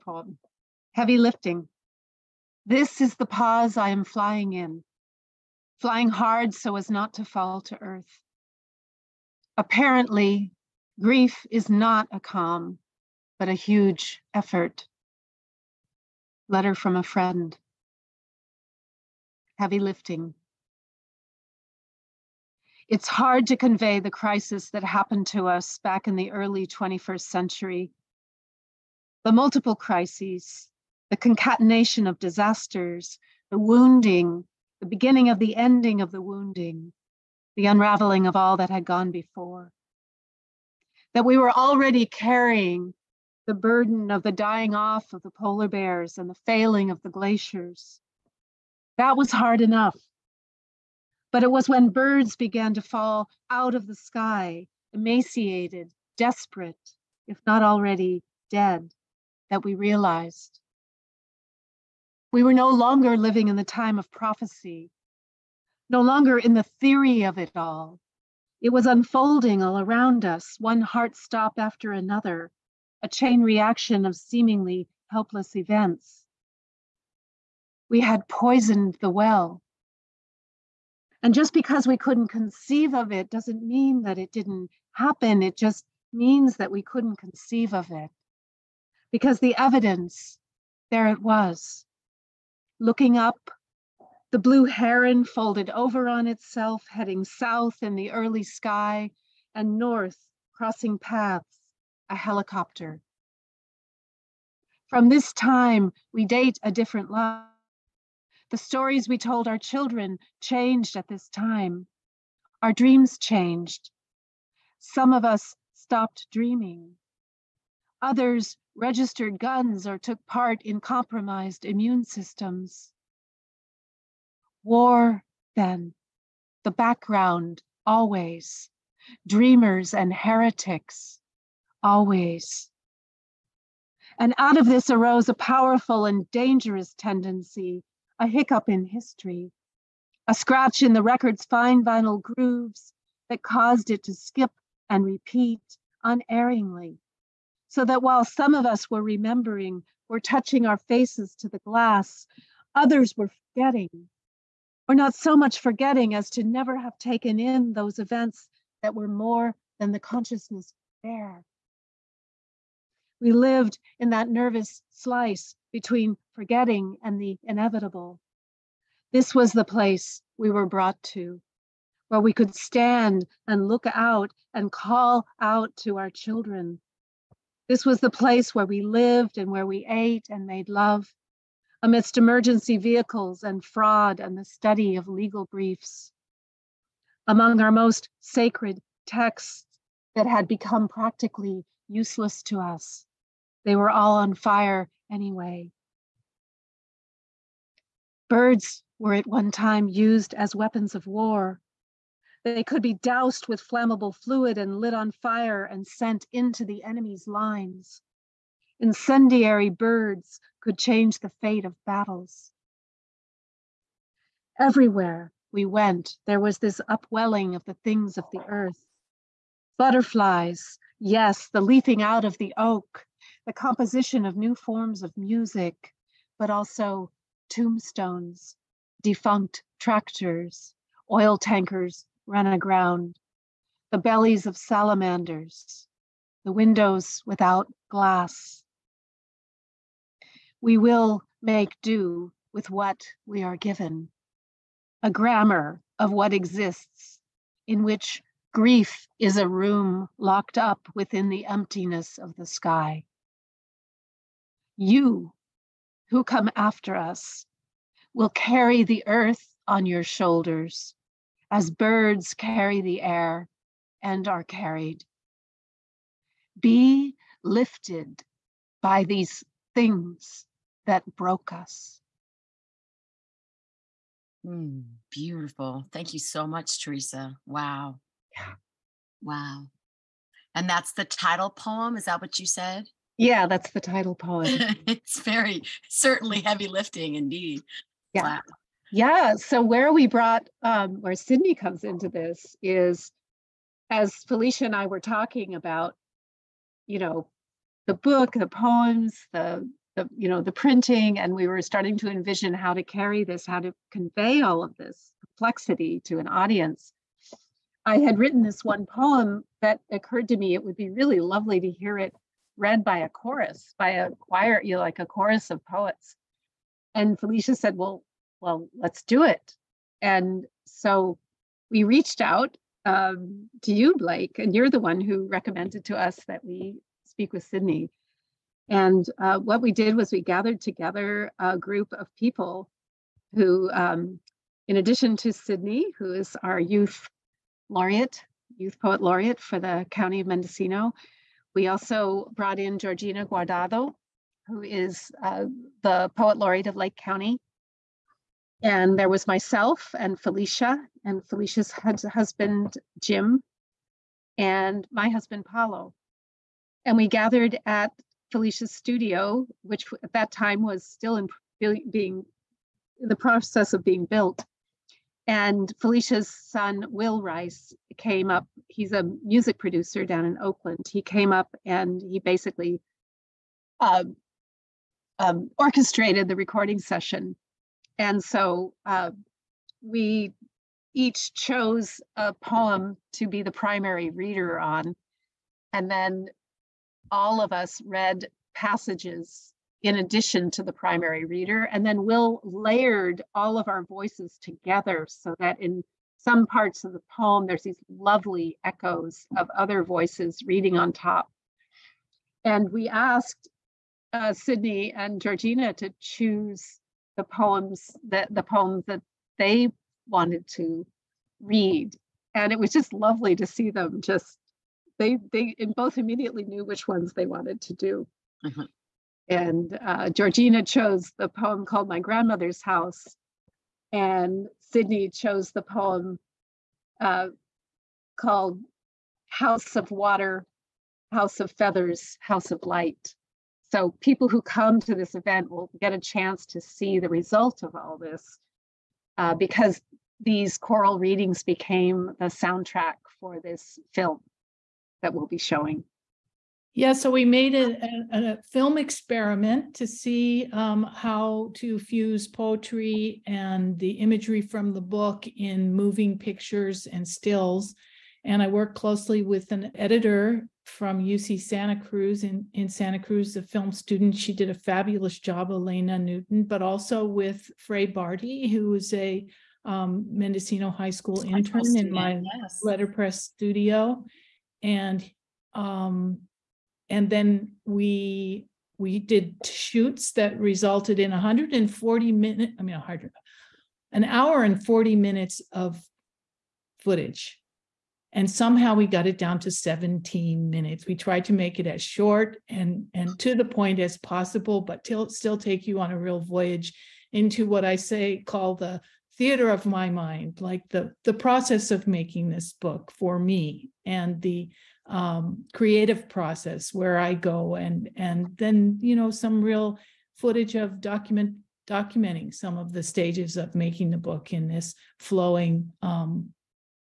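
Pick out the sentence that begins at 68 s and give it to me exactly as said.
It was unfolding all around us, one heart stop after another, a chain reaction of seemingly helpless events.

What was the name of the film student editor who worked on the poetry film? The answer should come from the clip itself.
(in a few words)
Elena Newton.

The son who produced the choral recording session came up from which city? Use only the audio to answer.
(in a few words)
Oakland.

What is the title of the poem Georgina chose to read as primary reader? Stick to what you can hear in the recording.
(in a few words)
My Grandmother's House.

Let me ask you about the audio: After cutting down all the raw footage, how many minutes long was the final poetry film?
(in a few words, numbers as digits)
17.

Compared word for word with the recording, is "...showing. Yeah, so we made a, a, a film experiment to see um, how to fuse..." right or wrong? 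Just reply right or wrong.
right.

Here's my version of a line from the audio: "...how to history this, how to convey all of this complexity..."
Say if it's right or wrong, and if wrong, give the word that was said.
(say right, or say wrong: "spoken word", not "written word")
wrong: "carry", not "history".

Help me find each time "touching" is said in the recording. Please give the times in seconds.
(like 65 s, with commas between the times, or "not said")
150 s.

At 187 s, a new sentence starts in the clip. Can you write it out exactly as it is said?
Among our most sacred texts that had become practically useless to us, they were all on fire anyway.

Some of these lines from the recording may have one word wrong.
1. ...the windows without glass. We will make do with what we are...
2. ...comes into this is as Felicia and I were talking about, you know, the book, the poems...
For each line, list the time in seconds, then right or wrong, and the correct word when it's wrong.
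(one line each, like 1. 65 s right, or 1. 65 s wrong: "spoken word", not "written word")
1. 236 s right
2. 291 s right.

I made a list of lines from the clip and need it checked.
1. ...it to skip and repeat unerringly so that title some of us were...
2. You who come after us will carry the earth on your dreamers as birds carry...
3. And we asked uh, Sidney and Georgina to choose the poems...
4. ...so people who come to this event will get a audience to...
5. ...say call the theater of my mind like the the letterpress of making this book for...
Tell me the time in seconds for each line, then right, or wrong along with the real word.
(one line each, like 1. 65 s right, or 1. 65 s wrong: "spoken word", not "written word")
1. 143 s wrong: "while", not "title"
2. 254 s wrong: "shoulders", not "dreamers"
3. 402 s right
4. 433 s wrong: "chance", not "audience"
5. 497 s wrong: "process", not "letterpress".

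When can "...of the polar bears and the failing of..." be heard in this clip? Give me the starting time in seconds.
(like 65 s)
45 s.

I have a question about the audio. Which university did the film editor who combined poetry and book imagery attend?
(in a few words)
UC Santa Cruz.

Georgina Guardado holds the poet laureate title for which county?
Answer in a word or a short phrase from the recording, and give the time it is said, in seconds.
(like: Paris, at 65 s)
Lake County, at 346 s.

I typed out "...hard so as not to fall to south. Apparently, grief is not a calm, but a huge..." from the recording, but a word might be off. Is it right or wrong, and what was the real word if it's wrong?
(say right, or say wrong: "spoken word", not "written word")
wrong: "earth", not "south".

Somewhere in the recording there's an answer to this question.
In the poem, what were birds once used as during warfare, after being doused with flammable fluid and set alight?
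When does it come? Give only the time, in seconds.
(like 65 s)
200 s.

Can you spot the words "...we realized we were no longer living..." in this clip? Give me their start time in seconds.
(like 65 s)
59 s.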